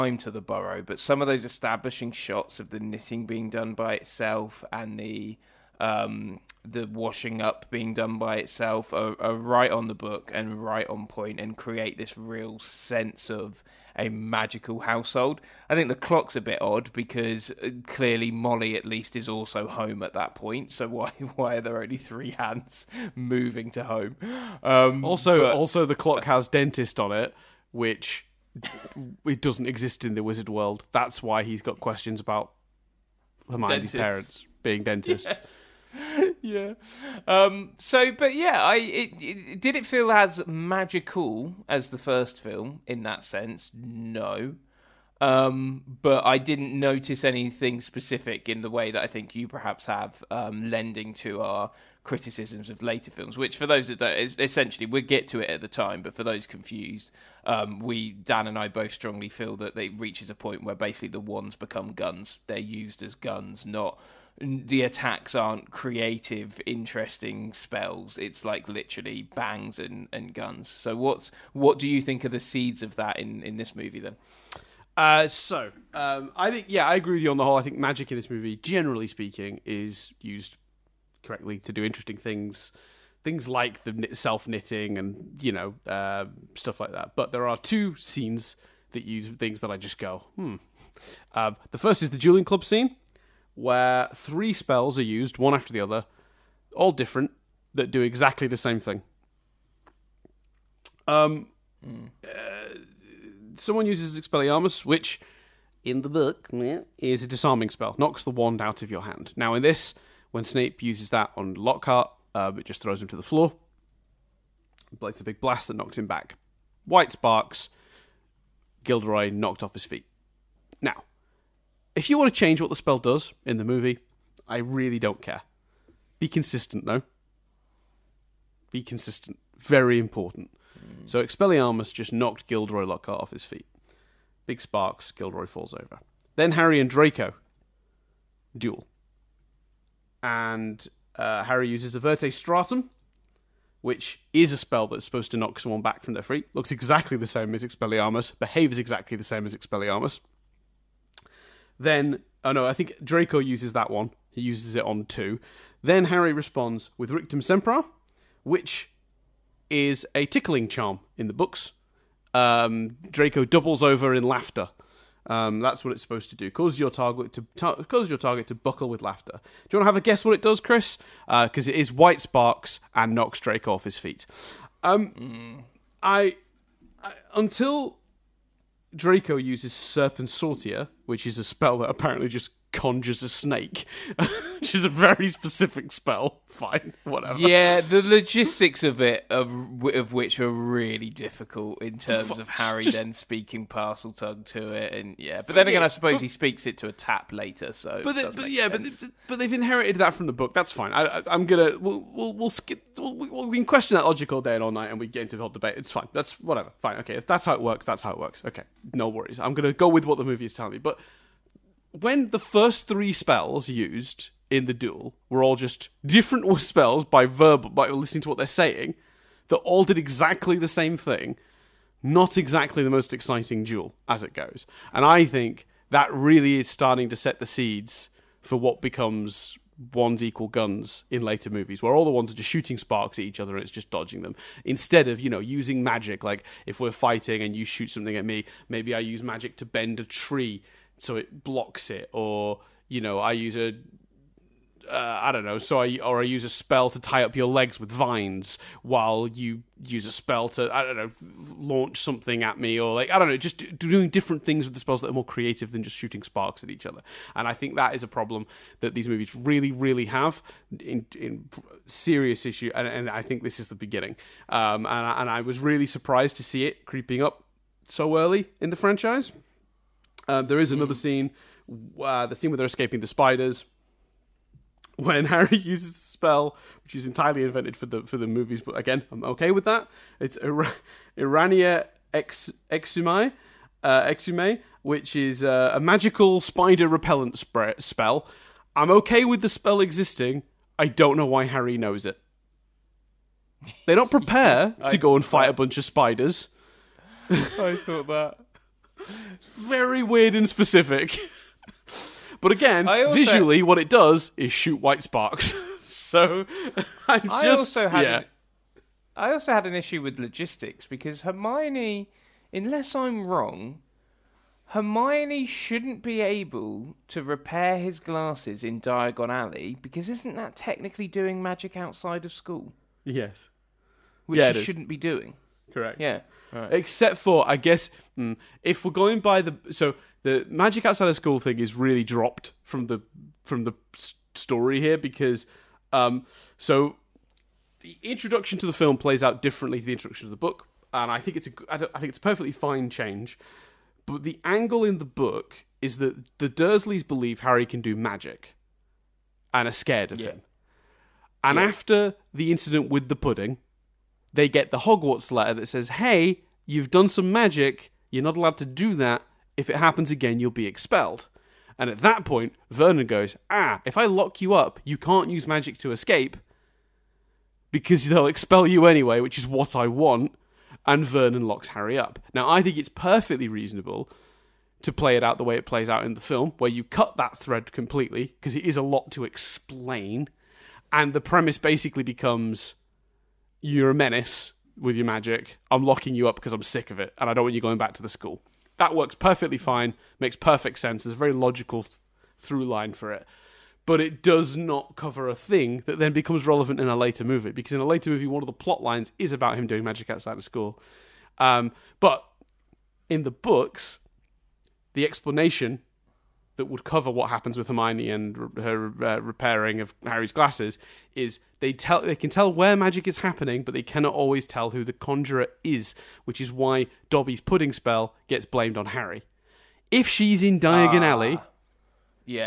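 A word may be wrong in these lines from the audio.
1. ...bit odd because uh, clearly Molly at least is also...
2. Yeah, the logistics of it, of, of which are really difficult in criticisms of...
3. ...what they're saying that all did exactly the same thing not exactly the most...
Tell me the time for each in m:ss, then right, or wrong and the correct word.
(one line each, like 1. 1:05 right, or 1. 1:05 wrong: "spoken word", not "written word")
1. 0:16 right
2. 3:07 wrong: "terms", not "criticisms"
3. 3:38 right.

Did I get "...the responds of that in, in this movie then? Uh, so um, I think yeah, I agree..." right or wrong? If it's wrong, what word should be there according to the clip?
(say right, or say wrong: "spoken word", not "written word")
wrong: "seeds", not "responds".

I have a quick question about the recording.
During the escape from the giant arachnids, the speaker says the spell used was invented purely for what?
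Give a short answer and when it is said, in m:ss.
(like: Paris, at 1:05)
The movies, at 4:38.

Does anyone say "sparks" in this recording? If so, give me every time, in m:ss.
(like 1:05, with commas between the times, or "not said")
1:57, 2:14, 2:52, 3:52, 4:16, 5:05.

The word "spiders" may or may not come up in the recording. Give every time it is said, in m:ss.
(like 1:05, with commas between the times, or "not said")
4:33, 4:46, 4:55.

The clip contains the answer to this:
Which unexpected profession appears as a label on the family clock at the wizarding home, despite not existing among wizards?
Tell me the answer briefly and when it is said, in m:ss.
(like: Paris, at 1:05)
Dentist, at 0:26.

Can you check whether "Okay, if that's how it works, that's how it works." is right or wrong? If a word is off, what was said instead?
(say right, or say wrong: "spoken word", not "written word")
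right.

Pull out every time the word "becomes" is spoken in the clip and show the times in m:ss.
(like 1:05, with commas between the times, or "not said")
1:01, 3:48, 6:22, 6:36.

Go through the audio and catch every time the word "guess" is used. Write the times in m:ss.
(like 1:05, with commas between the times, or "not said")
2:50, 5:27.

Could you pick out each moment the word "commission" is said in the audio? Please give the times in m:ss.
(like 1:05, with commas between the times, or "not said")
not said.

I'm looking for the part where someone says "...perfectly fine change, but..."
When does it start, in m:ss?
5:42.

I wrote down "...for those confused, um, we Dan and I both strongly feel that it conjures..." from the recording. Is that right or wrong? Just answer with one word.
wrong.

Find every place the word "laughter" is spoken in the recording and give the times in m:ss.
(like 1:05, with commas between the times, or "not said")
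2:44, 2:49.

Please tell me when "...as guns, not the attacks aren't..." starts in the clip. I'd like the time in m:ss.
1:03.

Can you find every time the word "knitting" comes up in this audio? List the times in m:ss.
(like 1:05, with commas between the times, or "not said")
0:02, 1:24.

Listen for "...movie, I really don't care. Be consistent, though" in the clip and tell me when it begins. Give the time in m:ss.
2:03.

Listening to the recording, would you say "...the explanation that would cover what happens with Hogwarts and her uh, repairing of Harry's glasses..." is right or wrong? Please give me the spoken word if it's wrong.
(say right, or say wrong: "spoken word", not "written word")
wrong: "Hermione", not "Hogwarts".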